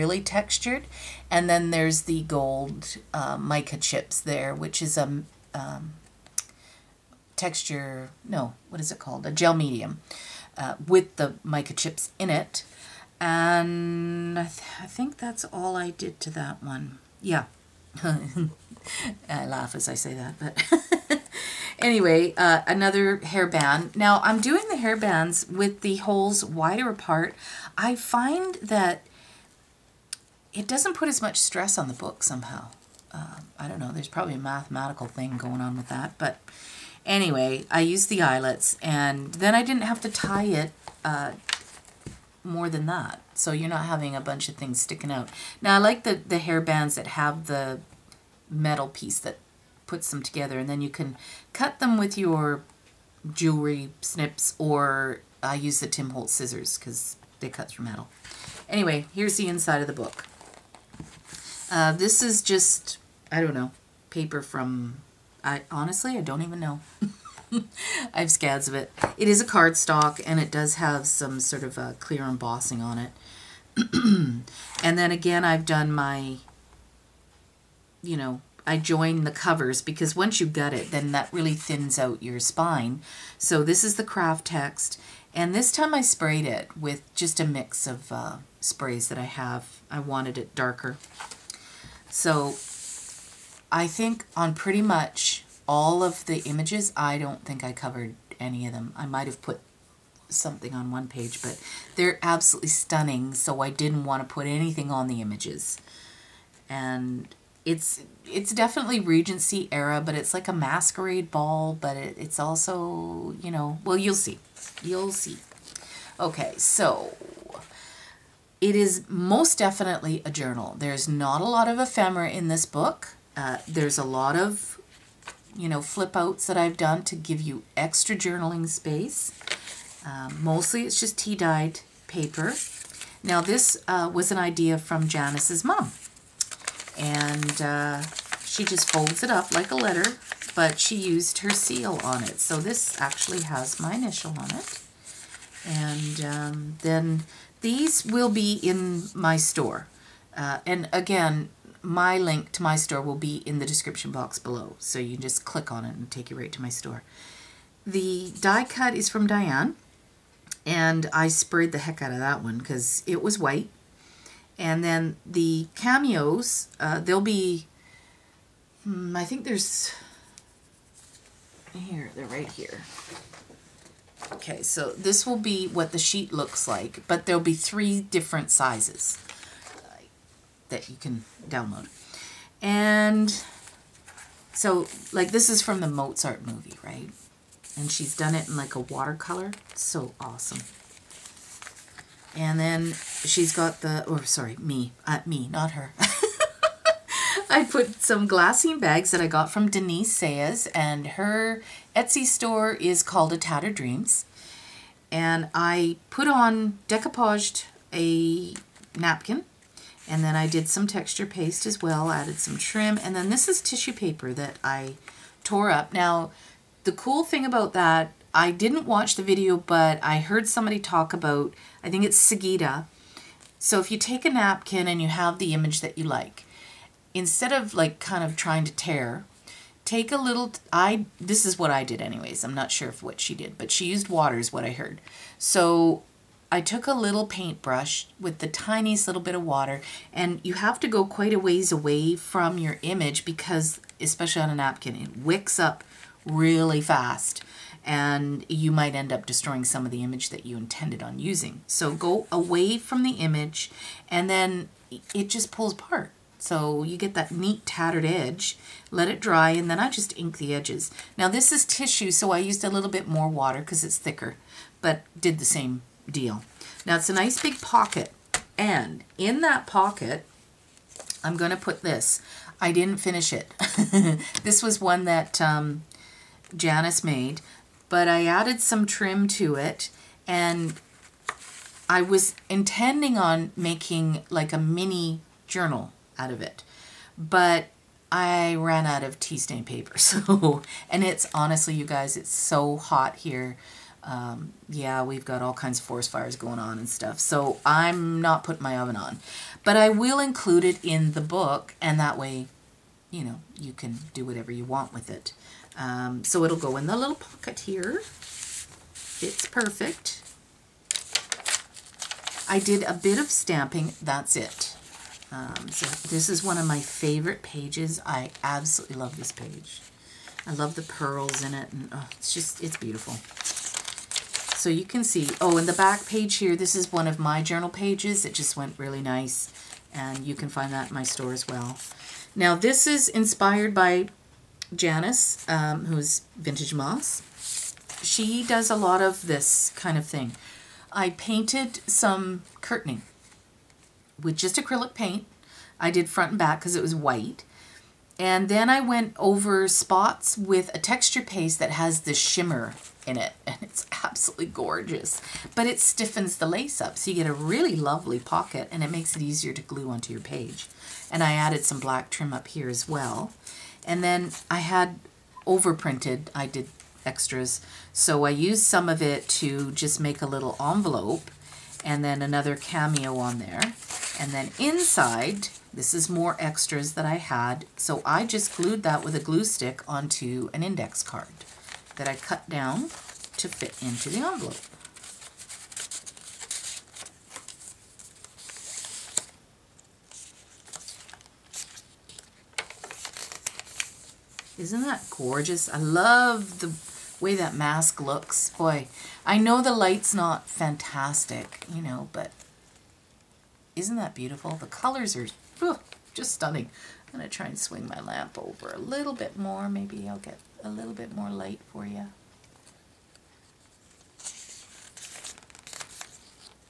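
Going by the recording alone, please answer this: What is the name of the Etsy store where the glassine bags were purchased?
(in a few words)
A Tattered Dreams.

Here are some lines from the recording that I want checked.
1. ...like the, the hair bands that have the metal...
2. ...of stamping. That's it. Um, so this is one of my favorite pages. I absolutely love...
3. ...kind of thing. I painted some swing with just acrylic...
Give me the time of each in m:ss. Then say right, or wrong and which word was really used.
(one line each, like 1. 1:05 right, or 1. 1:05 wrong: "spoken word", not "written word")
1. 0:45 right
2. 5:13 right
3. 5:39 wrong: "curtaining", not "swing".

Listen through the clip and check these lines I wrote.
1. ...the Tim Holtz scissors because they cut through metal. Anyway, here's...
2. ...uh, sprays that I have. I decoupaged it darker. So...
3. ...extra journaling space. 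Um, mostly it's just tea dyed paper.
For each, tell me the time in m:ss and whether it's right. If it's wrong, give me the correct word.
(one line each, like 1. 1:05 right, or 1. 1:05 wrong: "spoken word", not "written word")
1. 0:55 right
2. 1:28 wrong: "wanted", not "decoupaged"
3. 2:07 right.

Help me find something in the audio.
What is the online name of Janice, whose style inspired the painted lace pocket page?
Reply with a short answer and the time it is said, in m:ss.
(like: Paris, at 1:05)
Vintage Moss, at 5:36.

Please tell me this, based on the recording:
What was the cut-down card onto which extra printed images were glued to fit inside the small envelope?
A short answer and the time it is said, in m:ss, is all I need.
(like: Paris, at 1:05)
index card, at 6:20.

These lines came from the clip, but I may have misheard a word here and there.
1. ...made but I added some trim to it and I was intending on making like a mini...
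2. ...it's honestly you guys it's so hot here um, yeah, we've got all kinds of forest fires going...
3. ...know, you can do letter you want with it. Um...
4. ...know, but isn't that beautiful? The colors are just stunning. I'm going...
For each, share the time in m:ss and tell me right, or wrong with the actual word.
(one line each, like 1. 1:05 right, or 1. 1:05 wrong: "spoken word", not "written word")
1. 4:37 right
2. 4:51 right
3. 5:03 wrong: "whatever", not "letter"
4. 6:41 right.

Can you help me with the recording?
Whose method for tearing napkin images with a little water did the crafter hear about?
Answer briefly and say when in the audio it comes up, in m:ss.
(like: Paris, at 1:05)
Sagita, at 3:42.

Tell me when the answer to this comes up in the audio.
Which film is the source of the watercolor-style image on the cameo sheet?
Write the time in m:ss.
3:05.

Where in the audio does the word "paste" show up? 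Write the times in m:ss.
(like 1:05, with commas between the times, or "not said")
3:31, 5:51.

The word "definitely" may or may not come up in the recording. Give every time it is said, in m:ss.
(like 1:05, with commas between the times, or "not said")
1:48, 1:59.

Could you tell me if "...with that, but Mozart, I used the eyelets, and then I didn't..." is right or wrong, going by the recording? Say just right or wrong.
wrong.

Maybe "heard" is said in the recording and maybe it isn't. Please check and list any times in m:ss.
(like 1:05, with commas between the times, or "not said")
3:40, 3:54.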